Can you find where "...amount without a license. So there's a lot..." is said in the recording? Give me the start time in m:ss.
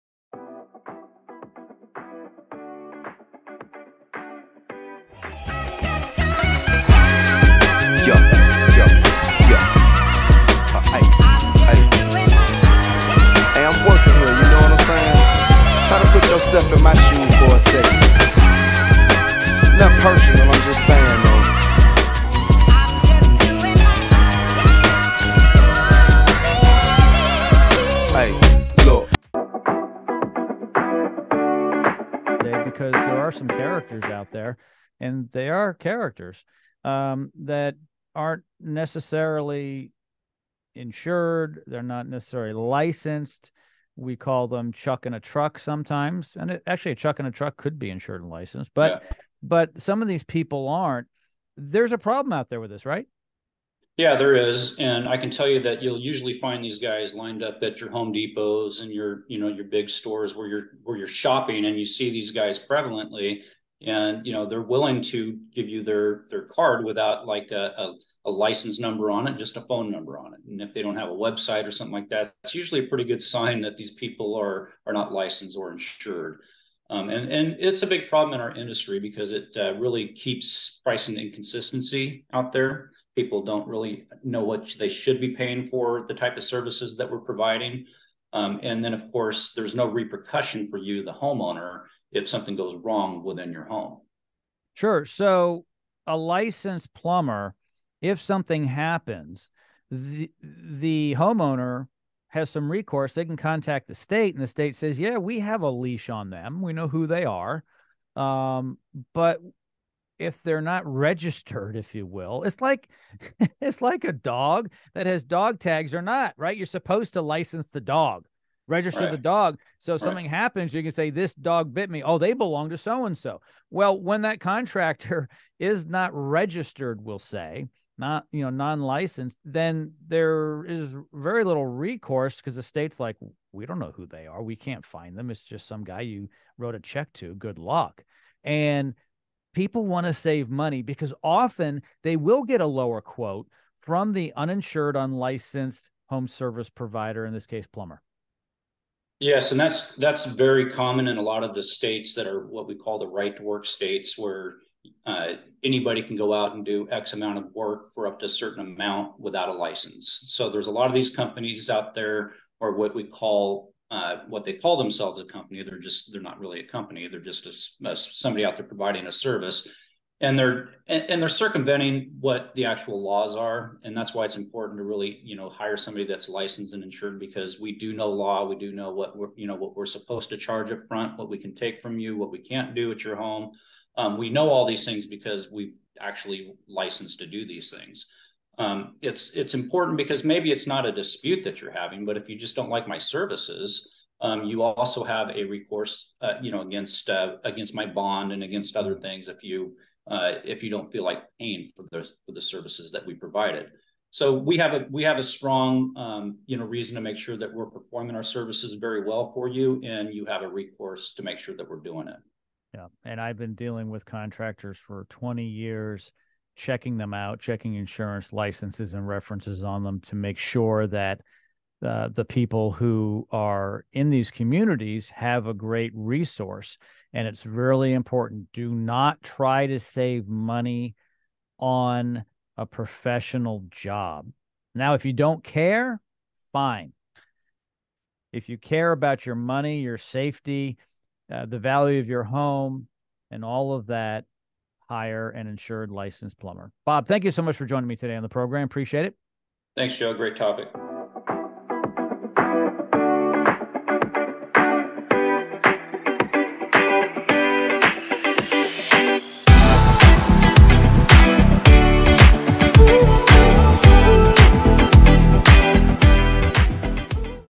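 2:38.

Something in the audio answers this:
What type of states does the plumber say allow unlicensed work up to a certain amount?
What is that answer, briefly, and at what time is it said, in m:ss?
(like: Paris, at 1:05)
right to work states, at 2:33.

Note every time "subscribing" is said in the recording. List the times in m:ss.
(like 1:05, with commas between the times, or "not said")
not said.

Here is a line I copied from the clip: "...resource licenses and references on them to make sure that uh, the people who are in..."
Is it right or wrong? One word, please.
wrong.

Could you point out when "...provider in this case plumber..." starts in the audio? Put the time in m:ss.
2:26.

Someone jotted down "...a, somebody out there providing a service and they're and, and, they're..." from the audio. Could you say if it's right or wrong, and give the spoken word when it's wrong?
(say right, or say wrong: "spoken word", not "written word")
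right.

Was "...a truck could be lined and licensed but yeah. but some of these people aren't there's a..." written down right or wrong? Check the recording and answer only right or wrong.
wrong.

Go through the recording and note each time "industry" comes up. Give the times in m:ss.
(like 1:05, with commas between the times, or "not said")
1:18.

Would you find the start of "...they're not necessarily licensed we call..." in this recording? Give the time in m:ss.
0:41.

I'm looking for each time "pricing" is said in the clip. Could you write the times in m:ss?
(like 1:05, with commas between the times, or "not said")
1:20.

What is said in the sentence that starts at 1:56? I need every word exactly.
You're supposed to license the dog register right.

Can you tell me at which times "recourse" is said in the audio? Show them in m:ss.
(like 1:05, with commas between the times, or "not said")
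1:42, 2:11, 3:15, 3:30.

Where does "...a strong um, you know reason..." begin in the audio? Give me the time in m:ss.
3:25.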